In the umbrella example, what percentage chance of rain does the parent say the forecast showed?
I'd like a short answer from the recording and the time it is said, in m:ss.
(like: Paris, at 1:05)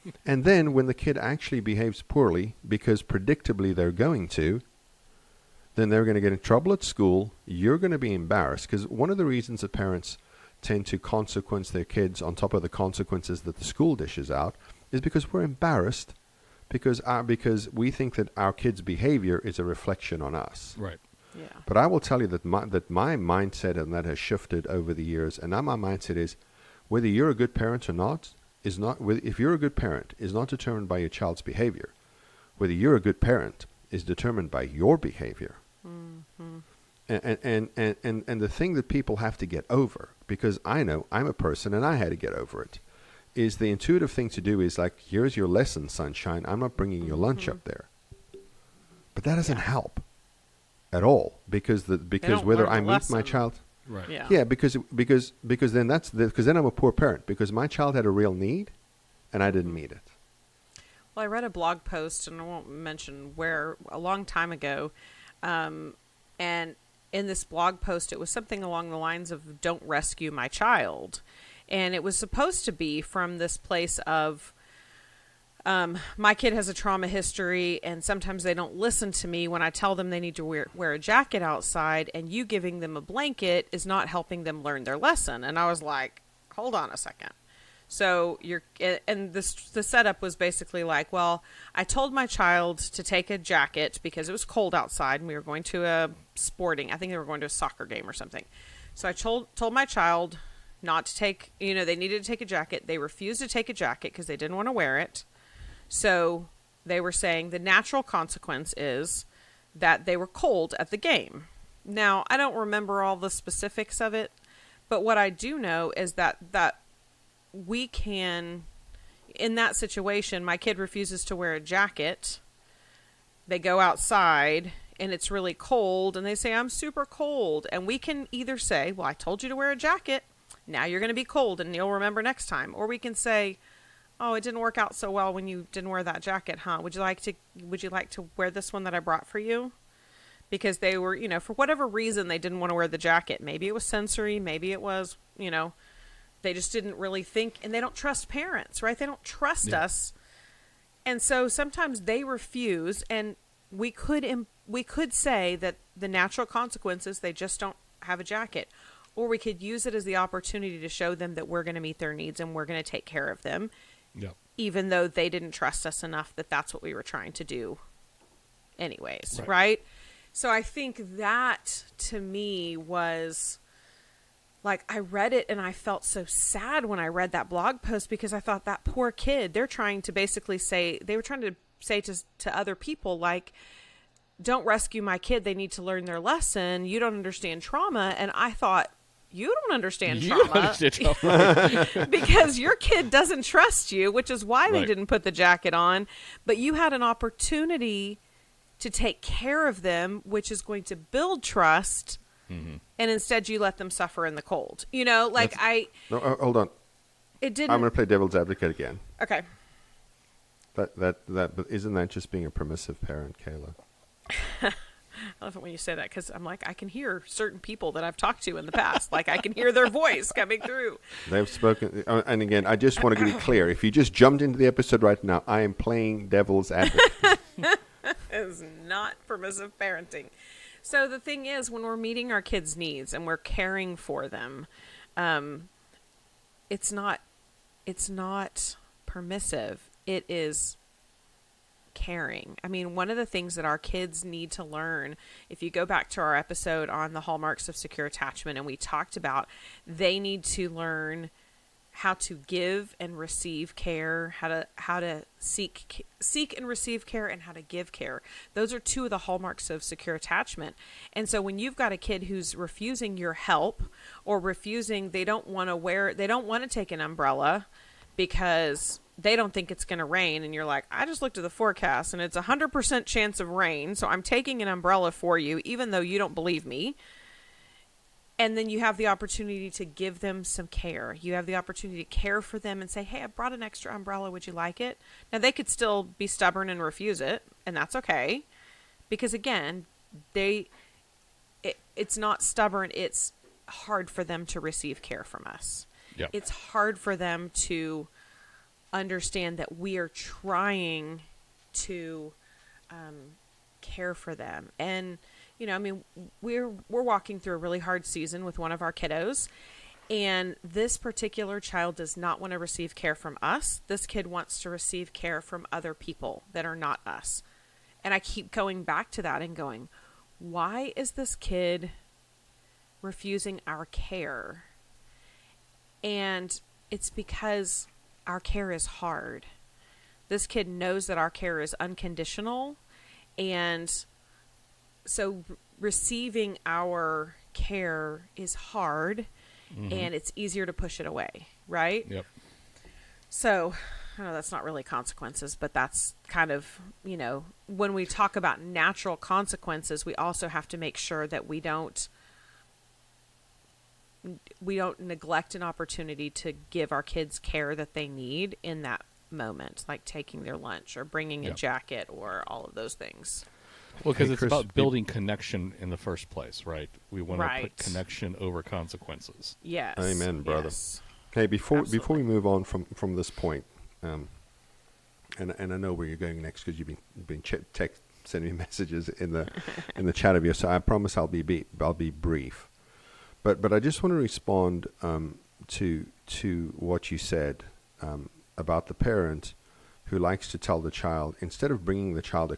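100%, at 4:32.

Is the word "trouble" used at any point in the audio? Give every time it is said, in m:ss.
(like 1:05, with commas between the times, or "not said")
0:06.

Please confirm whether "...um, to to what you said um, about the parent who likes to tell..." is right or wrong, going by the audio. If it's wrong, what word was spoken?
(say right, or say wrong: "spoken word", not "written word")
right.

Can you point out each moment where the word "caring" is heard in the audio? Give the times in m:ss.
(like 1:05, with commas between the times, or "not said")
3:53, 4:01.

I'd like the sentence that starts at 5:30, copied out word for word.
This kid knows that our care is unconditional.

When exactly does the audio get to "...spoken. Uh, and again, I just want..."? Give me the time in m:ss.
3:41.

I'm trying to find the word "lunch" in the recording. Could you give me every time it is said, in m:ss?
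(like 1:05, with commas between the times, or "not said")
0:47, 6:00.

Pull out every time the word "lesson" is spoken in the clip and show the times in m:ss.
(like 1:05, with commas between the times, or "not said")
0:45, 1:24, 3:06.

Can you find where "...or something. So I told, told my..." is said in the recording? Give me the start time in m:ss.
1:38.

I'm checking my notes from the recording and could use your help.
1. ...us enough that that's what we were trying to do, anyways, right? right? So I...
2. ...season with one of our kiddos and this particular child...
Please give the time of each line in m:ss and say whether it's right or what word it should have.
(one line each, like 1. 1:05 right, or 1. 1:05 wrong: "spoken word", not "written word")
1. 2:45 right
2. 5:08 right.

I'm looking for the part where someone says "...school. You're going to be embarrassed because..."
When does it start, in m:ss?
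0:06.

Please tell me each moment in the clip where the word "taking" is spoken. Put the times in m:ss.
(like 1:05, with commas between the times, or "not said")
4:34, 6:00.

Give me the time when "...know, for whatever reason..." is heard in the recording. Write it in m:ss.
2:21.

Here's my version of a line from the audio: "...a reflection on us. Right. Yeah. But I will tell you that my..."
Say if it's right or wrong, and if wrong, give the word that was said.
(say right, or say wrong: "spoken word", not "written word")
right.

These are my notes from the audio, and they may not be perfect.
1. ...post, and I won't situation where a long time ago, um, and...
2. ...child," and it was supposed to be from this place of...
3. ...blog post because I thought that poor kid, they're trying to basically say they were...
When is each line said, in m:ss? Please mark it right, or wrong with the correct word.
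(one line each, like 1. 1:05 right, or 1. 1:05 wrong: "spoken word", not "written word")
1. 1:01 wrong: "mention", not "situation"
2. 1:10 right
3. 2:57 right.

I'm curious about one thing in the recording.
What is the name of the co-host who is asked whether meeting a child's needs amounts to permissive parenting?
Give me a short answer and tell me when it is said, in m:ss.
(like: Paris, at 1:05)
Kayla, at 3:33.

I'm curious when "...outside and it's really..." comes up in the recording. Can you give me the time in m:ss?
2:03.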